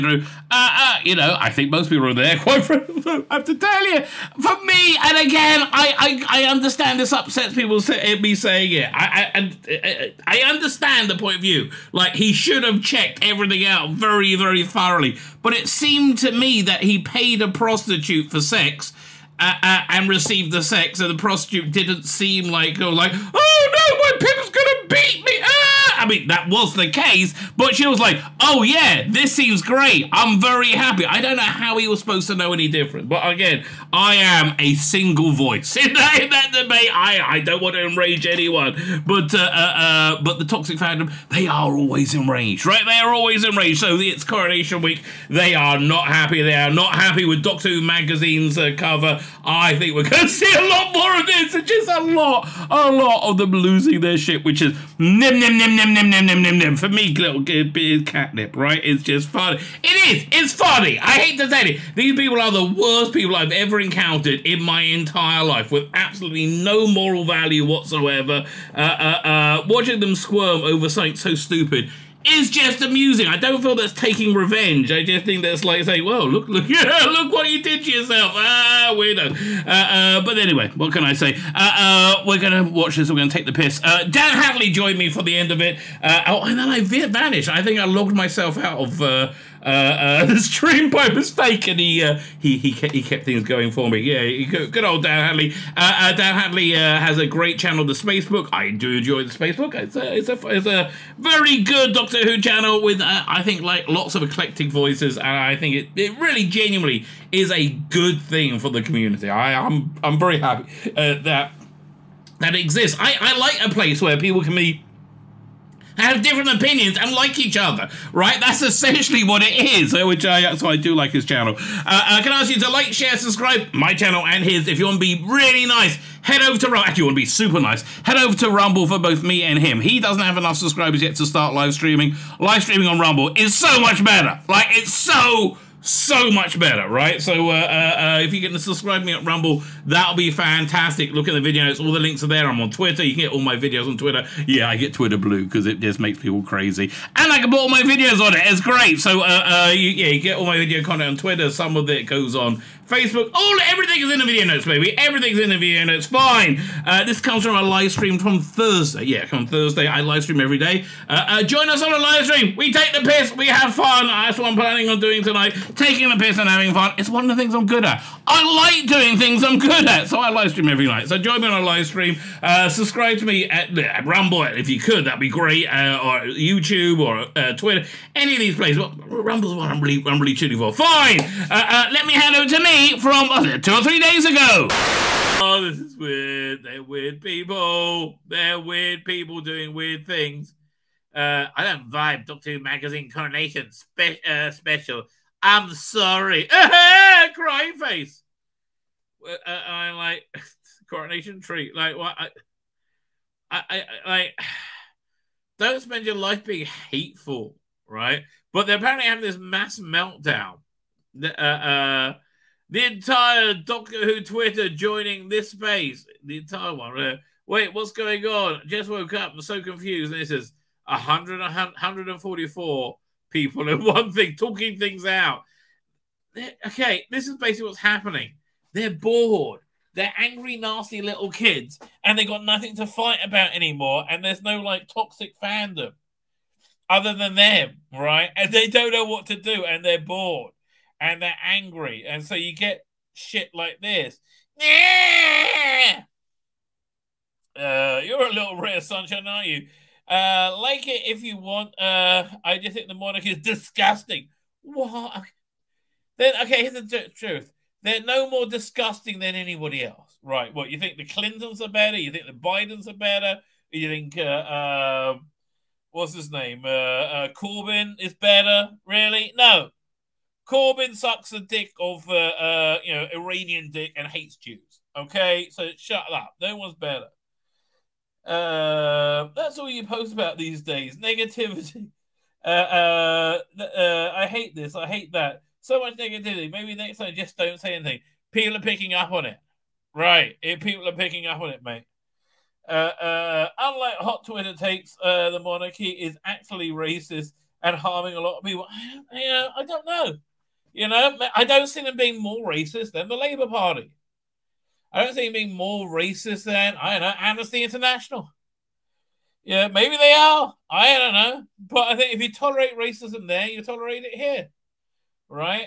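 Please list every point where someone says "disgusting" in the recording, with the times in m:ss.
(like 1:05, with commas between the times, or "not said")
4:13, 4:18.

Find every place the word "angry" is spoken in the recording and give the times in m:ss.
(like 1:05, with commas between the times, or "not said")
3:50, 4:01.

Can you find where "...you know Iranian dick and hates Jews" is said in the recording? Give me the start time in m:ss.
4:32.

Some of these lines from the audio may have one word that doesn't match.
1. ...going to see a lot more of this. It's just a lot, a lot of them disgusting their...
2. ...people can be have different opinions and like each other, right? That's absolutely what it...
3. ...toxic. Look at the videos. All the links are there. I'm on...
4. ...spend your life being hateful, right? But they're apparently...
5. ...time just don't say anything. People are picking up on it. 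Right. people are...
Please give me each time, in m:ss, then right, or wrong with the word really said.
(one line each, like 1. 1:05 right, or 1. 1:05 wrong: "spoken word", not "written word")
1. 0:50 wrong: "losing", not "disgusting"
2. 1:54 wrong: "essentially", not "absolutely"
3. 2:20 wrong: "fantastic", not "toxic"
4. 3:25 right
5. 4:46 right.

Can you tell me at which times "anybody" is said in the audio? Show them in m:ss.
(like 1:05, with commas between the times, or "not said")
4:19.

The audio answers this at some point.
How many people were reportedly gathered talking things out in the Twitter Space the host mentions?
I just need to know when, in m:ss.
3:41.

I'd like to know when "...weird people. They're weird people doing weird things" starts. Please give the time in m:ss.
3:06.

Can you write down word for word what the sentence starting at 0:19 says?
Uh, uh, and received the sex, and the prostitute didn't seem like, oh, like, oh no, my pimp's gonna beat me.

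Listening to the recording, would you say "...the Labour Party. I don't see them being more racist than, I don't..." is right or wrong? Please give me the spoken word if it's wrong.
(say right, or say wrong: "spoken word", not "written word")
right.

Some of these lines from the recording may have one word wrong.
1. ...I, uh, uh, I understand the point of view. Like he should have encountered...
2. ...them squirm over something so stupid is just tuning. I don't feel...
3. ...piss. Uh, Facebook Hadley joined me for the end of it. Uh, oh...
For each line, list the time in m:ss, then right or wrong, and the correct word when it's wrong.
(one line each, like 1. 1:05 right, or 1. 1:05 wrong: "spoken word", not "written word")
1. 0:09 wrong: "checked", not "encountered"
2. 1:09 wrong: "amusing", not "tuning"
3. 1:23 wrong: "Dan", not "Facebook".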